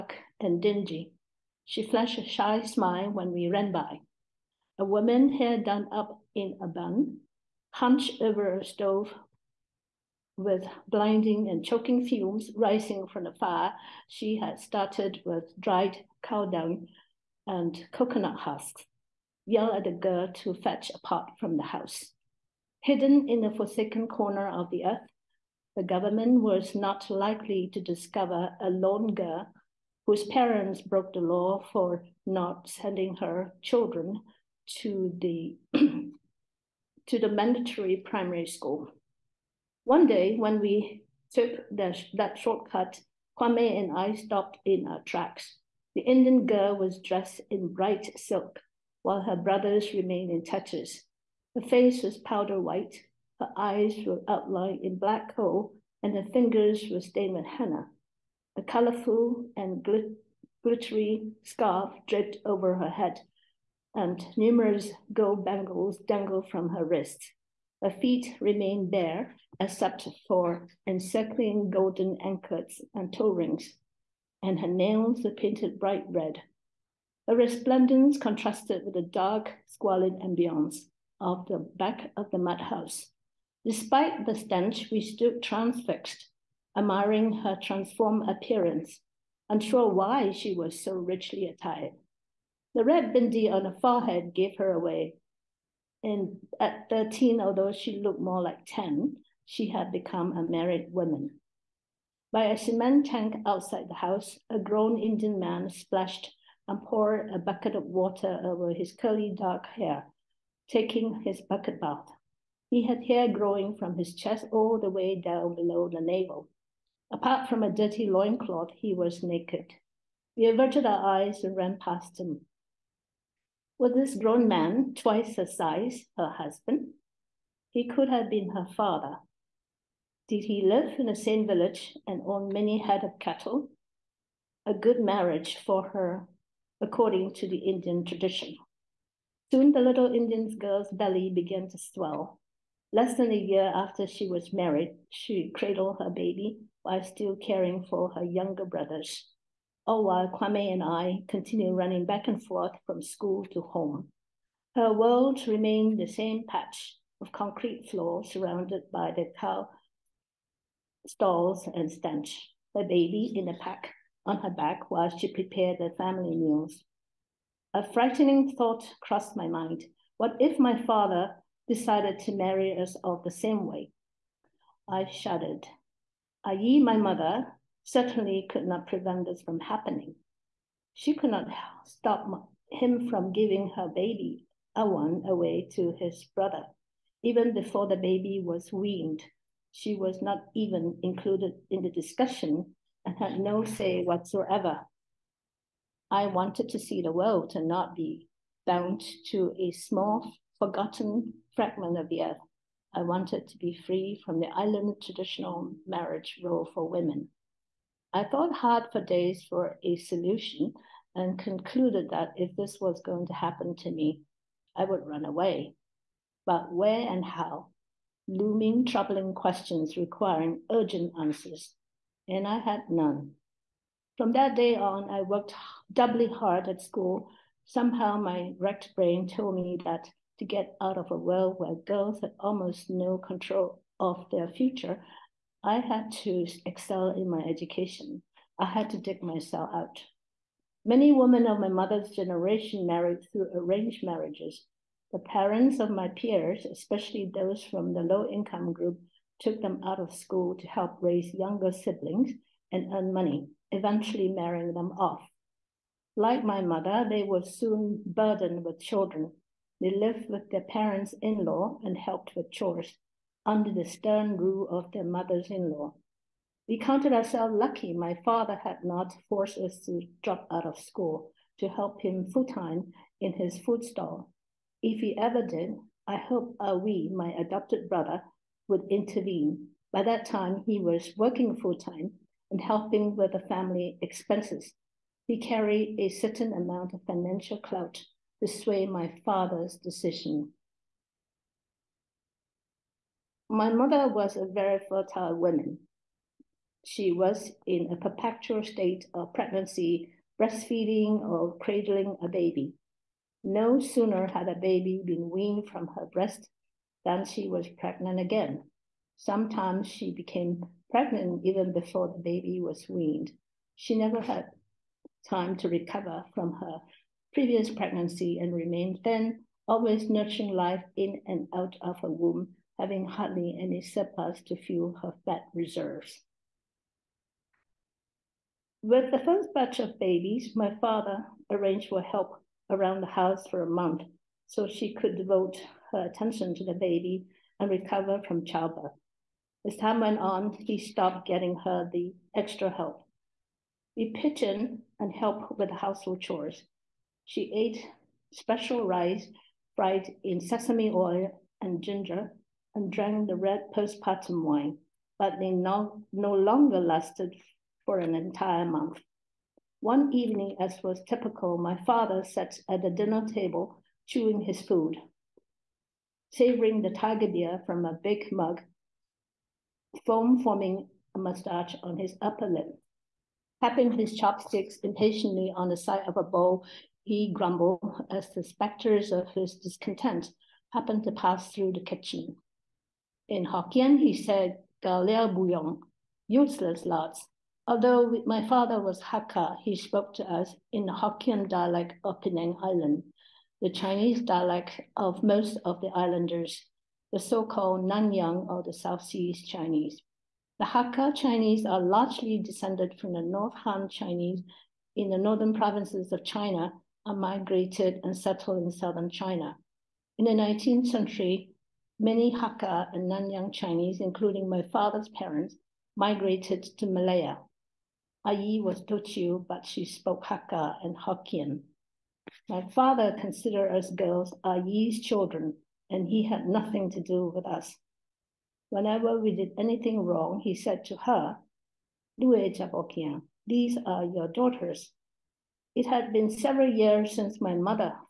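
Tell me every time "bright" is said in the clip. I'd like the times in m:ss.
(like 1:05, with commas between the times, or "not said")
0:47, 1:15.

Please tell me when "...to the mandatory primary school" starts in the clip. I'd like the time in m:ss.
0:37.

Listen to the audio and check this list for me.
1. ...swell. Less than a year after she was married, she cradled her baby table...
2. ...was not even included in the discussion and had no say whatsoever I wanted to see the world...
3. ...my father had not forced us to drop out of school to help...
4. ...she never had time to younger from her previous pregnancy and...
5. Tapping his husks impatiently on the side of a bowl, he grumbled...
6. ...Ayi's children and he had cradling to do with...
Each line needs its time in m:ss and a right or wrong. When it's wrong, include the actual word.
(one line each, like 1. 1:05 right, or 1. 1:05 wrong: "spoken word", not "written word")
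1. 2:21 wrong: "while", not "table"
2. 3:09 right
3. 4:27 right
4. 5:13 wrong: "recover", not "younger"
5. 6:13 wrong: "chopsticks", not "husks"
6. 7:04 wrong: "nothing", not "cradling".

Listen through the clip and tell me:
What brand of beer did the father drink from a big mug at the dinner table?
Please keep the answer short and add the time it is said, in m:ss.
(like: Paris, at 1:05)
Tiger, at 6:06.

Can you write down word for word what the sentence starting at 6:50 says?
In the 19th century, many Hakka and Nanyang Chinese, including my father's parents, migrated to Malaya.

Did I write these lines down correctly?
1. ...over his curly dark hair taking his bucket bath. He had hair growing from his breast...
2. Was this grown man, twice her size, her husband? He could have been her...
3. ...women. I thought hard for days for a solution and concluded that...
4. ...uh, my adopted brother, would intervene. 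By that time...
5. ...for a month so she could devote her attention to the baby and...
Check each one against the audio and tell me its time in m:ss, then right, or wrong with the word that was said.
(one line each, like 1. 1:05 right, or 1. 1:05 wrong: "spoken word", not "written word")
1. 1:48 wrong: "chest", not "breast"
2. 2:03 right
3. 3:26 right
4. 4:37 right
5. 5:33 right.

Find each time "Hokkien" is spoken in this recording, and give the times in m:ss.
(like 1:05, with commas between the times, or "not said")
6:23, 6:30, 7:00.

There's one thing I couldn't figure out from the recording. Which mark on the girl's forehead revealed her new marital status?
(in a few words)
Red bindi.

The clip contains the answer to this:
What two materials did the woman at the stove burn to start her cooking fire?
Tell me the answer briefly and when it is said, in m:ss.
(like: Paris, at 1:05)
Dried cow dung and coconut husks, at 0:15.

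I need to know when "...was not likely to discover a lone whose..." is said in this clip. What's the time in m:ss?
0:26.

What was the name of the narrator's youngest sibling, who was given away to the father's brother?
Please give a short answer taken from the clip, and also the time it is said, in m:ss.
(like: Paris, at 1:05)
Awan, at 3:04.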